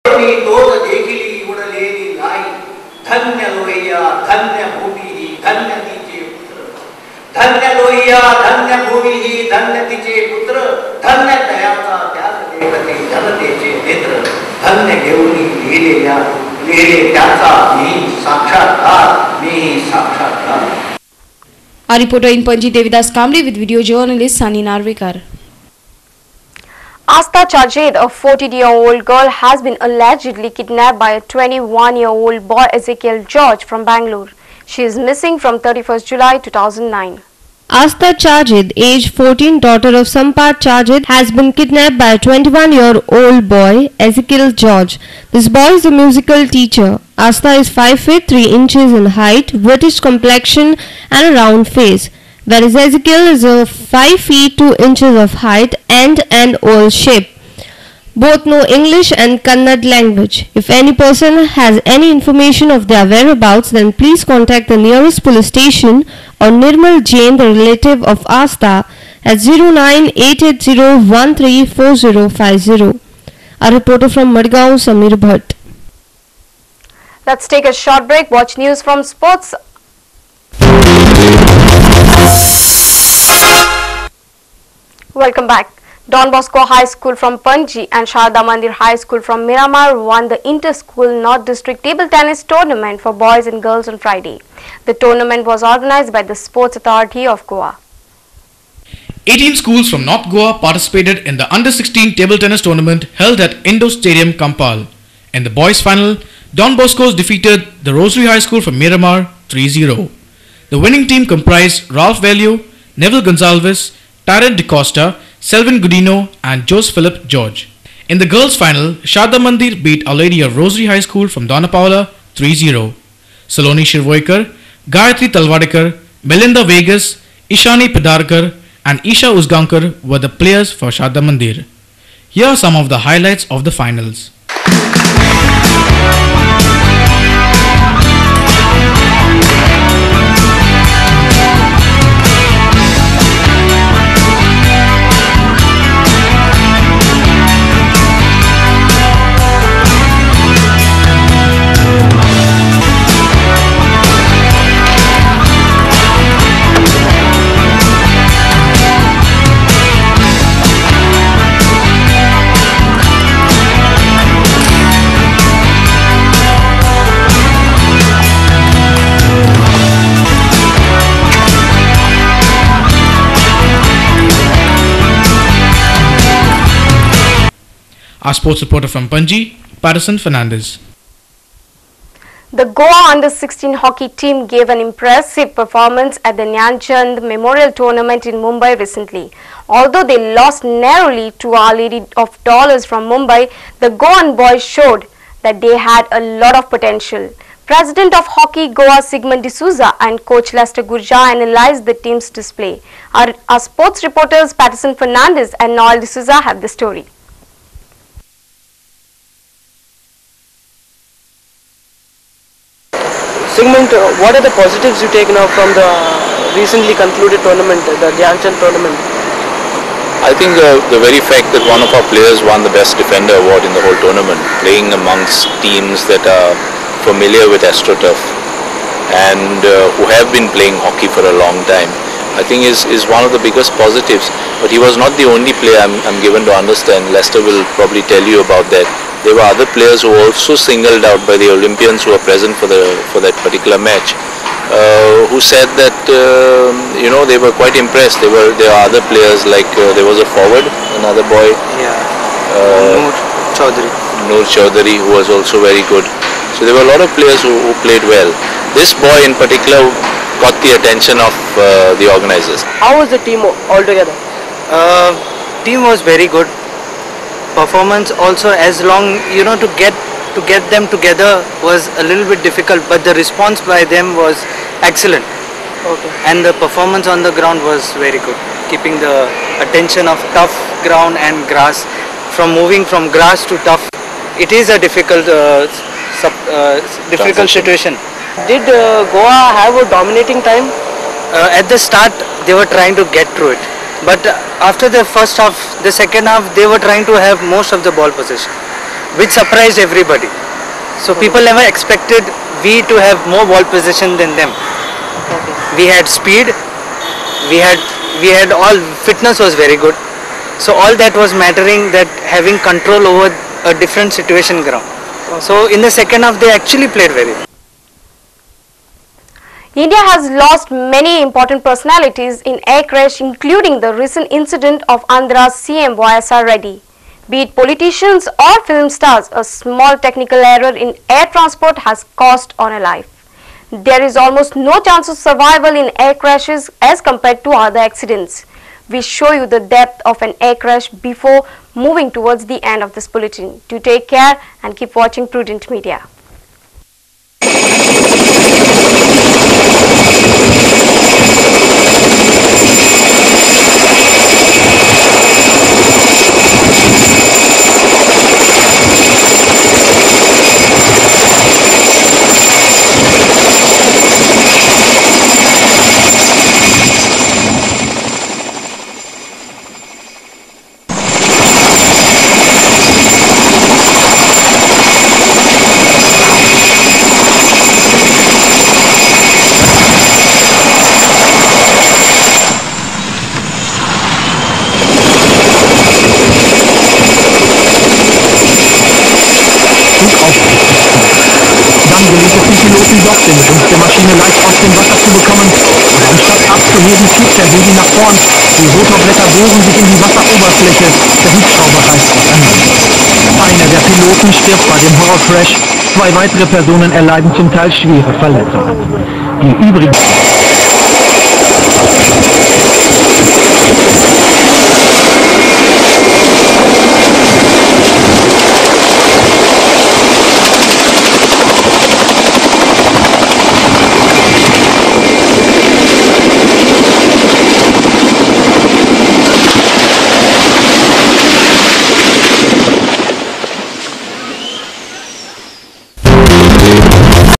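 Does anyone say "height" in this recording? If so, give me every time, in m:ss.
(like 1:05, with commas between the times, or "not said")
0:49, 0:55.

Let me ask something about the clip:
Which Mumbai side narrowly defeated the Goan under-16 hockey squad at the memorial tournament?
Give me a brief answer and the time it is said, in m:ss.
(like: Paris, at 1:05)
Our Lady of Dolours, at 3:11.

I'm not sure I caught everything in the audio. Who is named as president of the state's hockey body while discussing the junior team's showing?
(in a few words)
Sigmund D'Souza.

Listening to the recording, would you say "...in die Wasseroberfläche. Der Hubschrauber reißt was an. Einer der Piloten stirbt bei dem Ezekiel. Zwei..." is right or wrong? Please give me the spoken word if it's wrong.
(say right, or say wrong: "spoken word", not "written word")
wrong: "Horrorcrash", not "Ezekiel".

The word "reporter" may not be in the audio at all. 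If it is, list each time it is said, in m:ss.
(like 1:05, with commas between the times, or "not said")
1:13, 2:58, 3:24.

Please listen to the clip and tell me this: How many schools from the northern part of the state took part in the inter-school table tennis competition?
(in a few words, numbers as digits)
18.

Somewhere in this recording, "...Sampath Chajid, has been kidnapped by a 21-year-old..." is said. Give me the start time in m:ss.
0:40.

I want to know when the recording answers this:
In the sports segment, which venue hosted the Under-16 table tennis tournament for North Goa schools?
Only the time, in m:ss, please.
1:43.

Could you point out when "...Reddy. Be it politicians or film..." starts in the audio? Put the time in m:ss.
5:26.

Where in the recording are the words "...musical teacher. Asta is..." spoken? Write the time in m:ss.
0:45.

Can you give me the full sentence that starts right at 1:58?
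In the girls' final, Sharda Mandir beat Our Lady of Rosary High School from Dona Paula 3-0.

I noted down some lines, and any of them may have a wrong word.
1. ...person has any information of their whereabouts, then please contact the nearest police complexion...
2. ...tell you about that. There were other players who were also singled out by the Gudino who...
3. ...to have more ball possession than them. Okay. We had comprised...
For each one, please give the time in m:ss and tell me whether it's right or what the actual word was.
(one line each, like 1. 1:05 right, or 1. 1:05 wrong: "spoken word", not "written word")
1. 1:01 wrong: "station", not "complexion"
2. 3:58 wrong: "Olympians", not "Gudino"
3. 5:02 wrong: "speed", not "comprised".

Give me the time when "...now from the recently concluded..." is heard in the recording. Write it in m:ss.
3:35.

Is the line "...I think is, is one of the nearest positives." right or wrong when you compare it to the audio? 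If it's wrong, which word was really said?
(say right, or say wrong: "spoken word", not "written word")
wrong: "biggest", not "nearest".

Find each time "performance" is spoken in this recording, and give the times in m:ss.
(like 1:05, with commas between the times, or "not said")
3:05, 4:27, 4:36.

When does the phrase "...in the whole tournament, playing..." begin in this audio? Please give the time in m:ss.
3:43.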